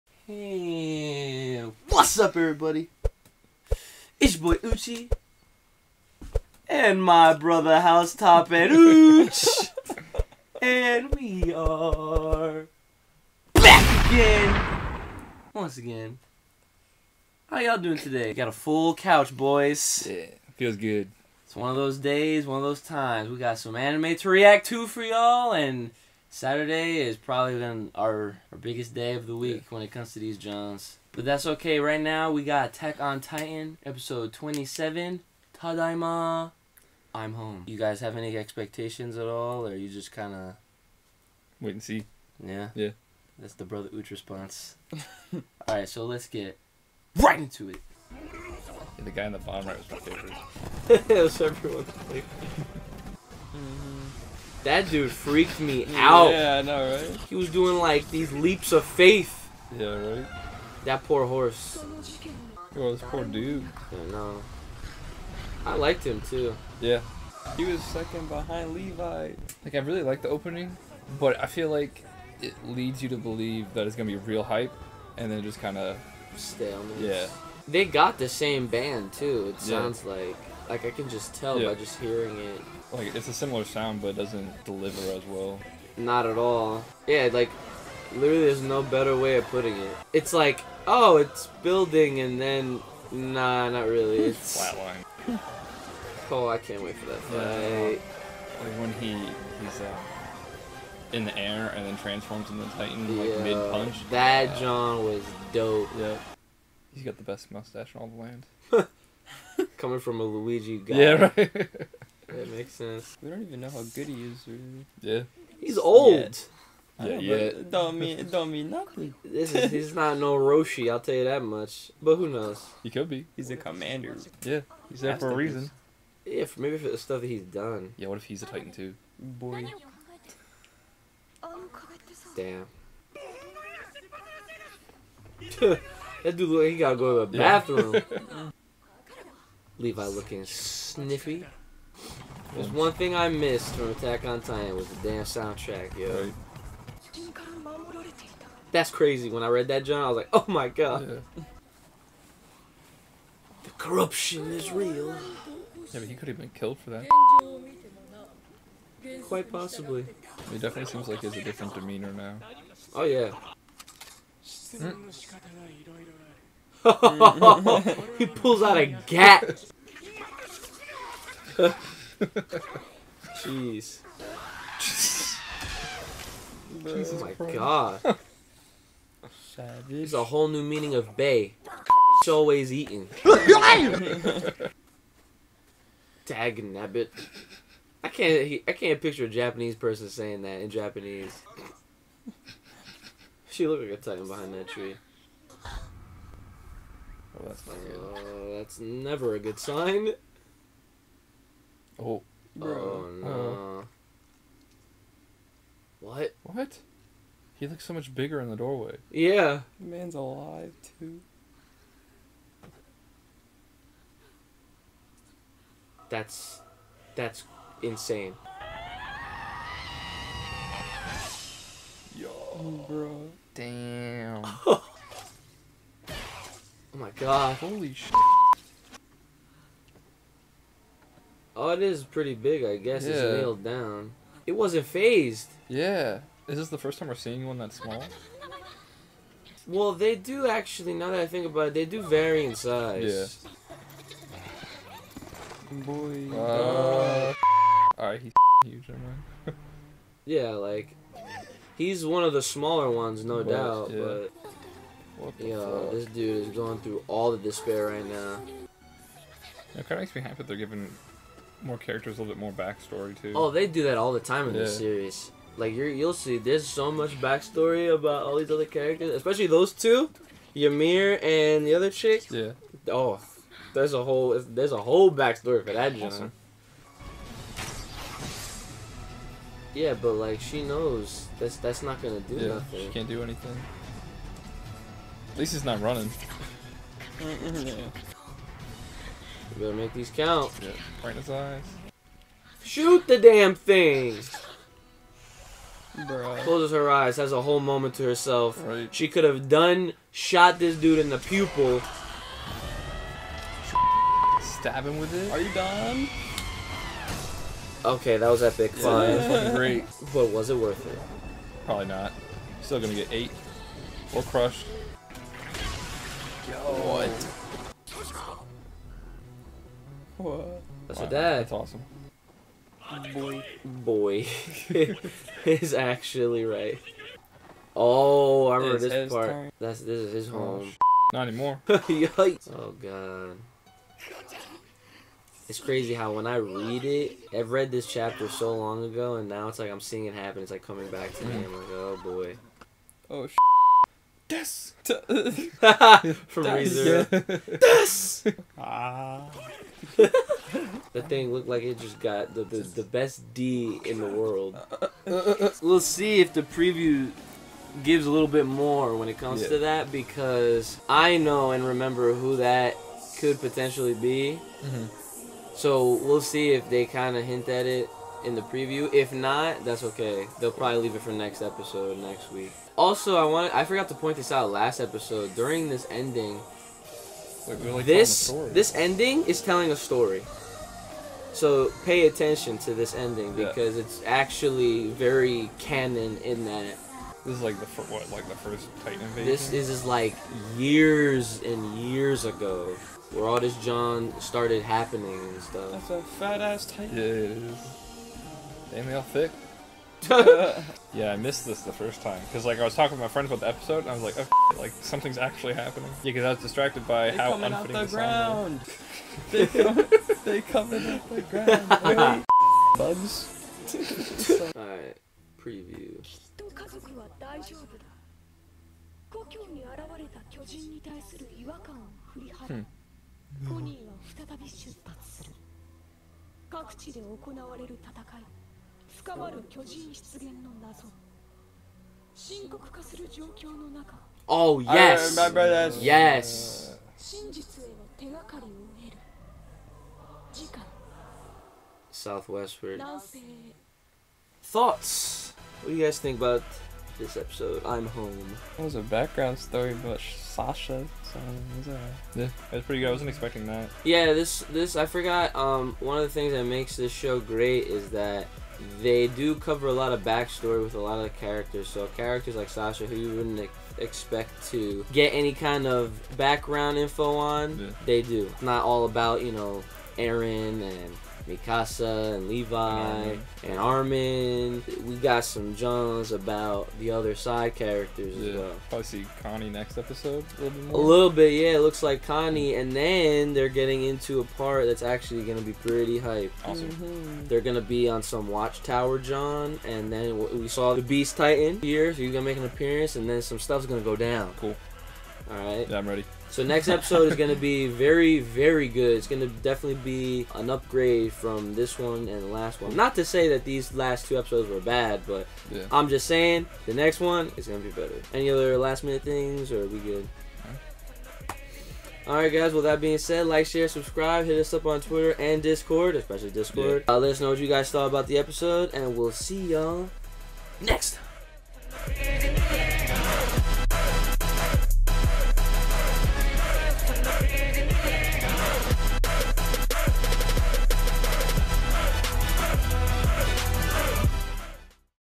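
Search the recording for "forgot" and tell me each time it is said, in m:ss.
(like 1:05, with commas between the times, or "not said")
6:13, 7:34.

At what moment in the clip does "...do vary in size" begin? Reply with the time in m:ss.
4:01.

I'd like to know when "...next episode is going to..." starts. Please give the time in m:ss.
8:16.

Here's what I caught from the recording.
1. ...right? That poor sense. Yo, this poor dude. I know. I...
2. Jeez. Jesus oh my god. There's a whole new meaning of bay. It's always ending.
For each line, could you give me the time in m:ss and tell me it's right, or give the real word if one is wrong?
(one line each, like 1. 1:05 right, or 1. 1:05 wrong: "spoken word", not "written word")
1. 0:59 wrong: "horse", not "sense"
2. 2:53 wrong: "eating", not "ending".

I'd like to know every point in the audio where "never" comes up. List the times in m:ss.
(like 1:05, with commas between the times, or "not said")
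3:18.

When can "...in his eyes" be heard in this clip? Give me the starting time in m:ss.
4:51.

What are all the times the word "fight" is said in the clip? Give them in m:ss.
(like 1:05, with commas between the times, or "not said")
1:37.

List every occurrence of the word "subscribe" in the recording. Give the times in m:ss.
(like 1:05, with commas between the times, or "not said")
8:33.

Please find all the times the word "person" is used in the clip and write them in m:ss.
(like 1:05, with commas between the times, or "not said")
3:09.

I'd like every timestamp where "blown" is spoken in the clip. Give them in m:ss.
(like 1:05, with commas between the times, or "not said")
not said.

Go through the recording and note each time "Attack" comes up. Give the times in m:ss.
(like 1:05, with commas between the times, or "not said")
0:32, 2:23.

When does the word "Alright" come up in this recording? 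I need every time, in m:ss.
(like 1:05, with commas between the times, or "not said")
4:08, 8:32.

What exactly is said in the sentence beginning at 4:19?
It kind of makes me happy that they're giving more characters a little bit more backstory too.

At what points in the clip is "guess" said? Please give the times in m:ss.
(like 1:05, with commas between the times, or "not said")
3:52.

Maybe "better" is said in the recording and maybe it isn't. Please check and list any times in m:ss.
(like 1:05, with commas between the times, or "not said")
1:28, 4:49, 8:27.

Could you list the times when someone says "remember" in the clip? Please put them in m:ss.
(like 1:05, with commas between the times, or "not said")
5:28, 6:01.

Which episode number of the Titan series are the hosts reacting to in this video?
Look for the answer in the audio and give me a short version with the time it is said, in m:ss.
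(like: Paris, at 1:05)
27, at 0:33.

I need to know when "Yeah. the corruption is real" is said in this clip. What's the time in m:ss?
2:31.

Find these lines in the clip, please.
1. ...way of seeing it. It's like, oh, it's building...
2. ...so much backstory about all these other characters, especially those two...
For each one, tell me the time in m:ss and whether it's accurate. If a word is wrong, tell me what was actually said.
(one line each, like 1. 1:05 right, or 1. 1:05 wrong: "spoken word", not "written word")
1. 1:29 wrong: "putting", not "seeing"
2. 4:26 right.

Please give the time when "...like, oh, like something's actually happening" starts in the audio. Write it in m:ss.
6:44.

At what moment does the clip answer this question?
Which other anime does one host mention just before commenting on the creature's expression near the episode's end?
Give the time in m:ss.
5:46.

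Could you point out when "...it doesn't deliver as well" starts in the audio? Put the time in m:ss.
1:24.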